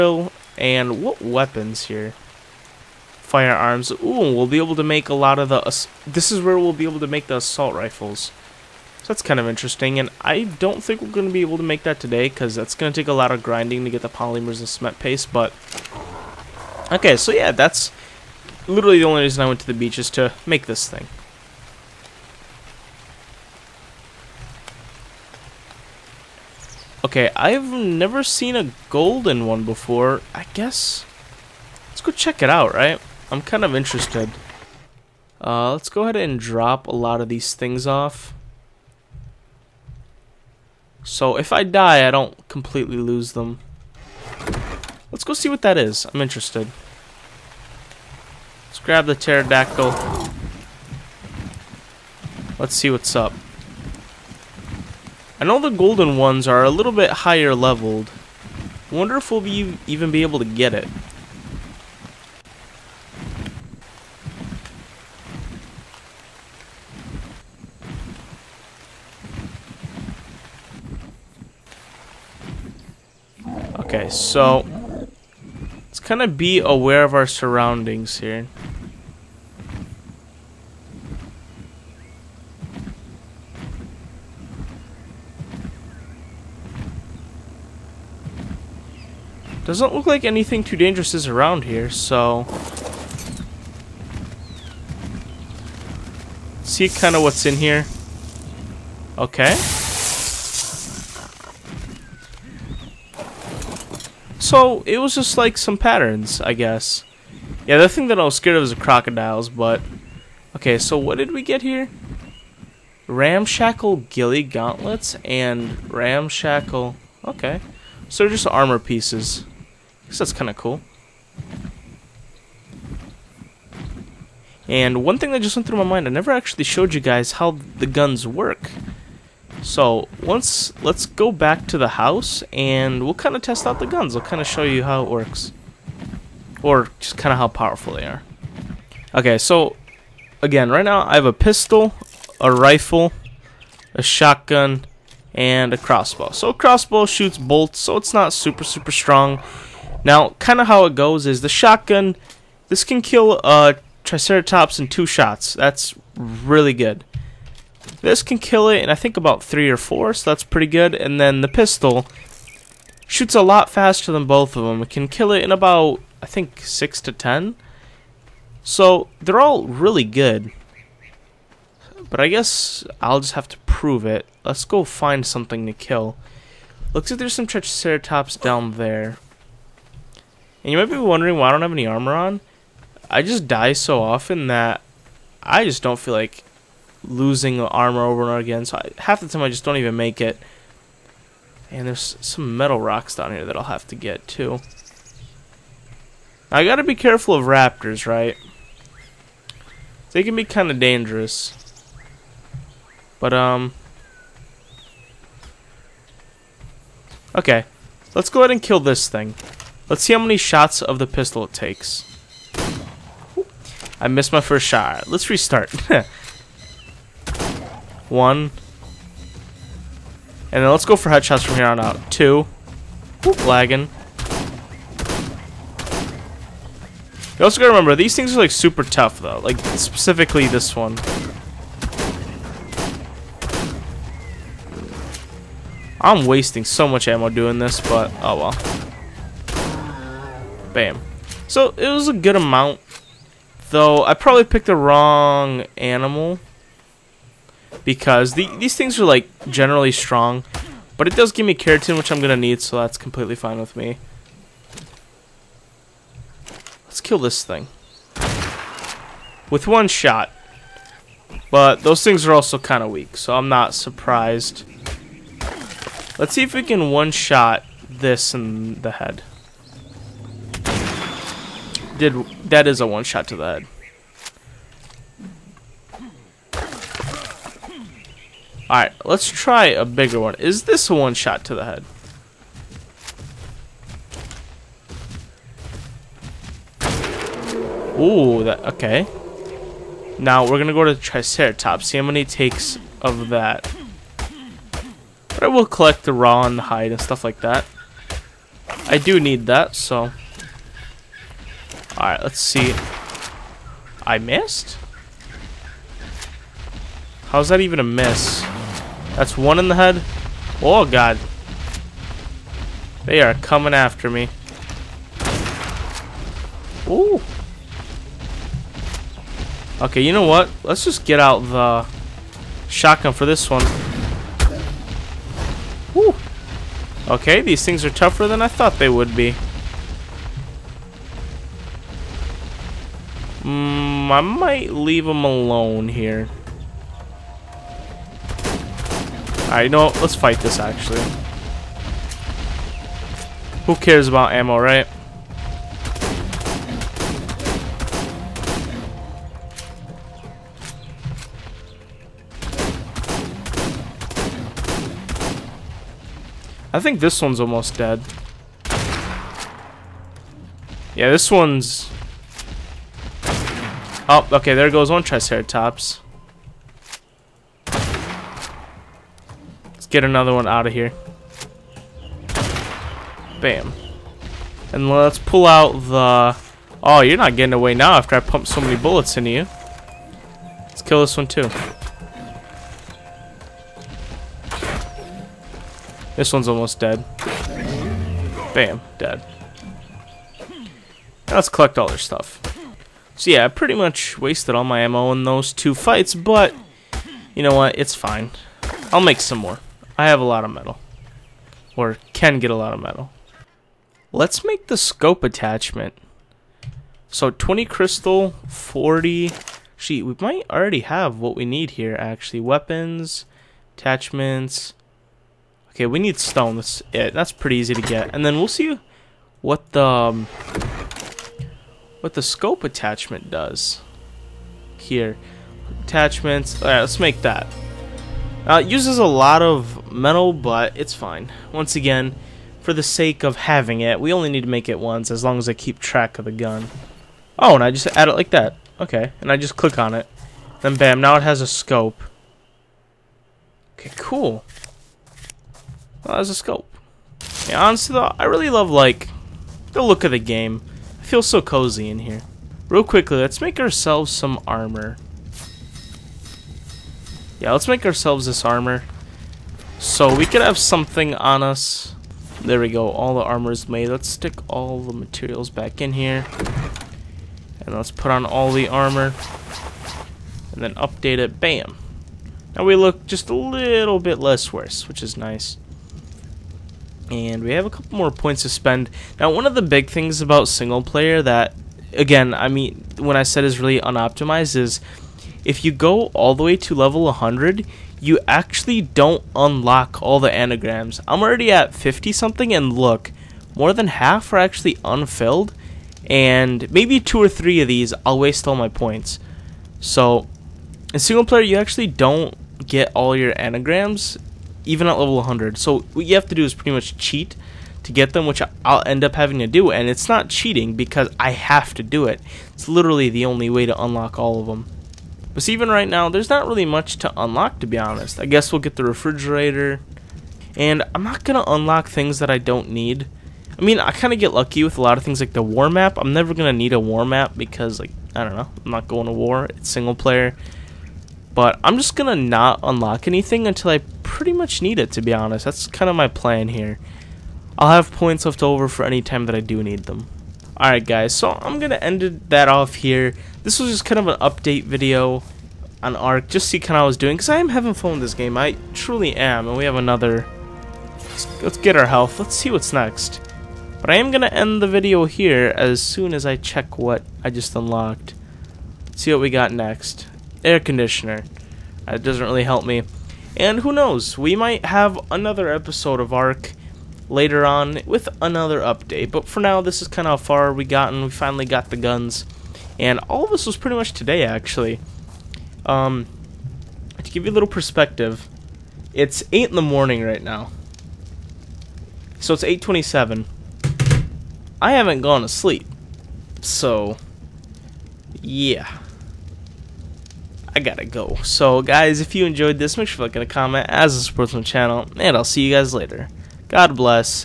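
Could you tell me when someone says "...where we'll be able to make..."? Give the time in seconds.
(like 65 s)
6 s.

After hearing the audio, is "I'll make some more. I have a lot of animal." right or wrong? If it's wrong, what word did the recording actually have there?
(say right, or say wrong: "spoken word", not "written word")
wrong: "metal", not "animal".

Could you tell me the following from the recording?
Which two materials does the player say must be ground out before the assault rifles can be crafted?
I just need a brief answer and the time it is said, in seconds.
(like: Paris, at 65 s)
polymers and cement paste, at 14 s.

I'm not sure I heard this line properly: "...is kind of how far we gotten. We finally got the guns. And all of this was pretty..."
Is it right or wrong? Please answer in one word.
right.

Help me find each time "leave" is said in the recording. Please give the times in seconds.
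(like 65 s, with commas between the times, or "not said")
334 s.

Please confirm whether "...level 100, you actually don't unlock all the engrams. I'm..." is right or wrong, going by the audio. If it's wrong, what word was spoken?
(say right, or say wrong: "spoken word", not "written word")
right.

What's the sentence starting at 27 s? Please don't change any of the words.
Okay, I've never seen a golden one before.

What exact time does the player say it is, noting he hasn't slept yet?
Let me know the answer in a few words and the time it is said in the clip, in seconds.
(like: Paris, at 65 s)
8:27, at 582 s.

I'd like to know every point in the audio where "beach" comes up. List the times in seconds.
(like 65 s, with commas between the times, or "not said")
19 s.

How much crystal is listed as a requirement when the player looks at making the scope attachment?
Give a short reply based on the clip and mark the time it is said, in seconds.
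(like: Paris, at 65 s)
20, at 407 s.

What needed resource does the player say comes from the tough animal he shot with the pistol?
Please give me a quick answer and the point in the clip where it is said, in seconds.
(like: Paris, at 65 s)
keratin, at 251 s.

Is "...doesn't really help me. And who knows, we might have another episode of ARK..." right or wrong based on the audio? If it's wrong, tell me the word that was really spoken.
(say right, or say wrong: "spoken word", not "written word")
right.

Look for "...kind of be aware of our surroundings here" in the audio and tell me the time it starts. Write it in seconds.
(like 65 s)
75 s.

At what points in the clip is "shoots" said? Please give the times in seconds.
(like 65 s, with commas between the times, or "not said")
147 s, 163 s.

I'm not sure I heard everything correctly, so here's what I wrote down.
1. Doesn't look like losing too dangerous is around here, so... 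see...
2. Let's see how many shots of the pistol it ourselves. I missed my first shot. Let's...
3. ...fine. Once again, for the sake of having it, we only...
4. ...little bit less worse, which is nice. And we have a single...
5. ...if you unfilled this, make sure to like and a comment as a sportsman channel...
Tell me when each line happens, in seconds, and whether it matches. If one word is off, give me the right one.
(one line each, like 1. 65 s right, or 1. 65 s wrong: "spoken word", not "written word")
1. 89 s wrong: "anything", not "losing"
2. 209 s wrong: "takes", not "ourselves"
3. 430 s right
4. 473 s wrong: "couple", not "single"
5. 591 s wrong: "enjoyed", not "unfilled".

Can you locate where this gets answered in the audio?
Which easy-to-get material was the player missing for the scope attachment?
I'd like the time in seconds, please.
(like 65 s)
416 s.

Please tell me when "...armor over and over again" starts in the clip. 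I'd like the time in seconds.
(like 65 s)
187 s.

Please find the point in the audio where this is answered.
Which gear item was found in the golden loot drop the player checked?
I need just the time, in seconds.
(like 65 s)
113 s.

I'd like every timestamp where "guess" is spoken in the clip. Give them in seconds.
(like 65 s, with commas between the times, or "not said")
30 s, 106 s, 120 s, 172 s, 518 s.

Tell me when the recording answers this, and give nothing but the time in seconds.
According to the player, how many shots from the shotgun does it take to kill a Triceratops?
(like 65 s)
154 s.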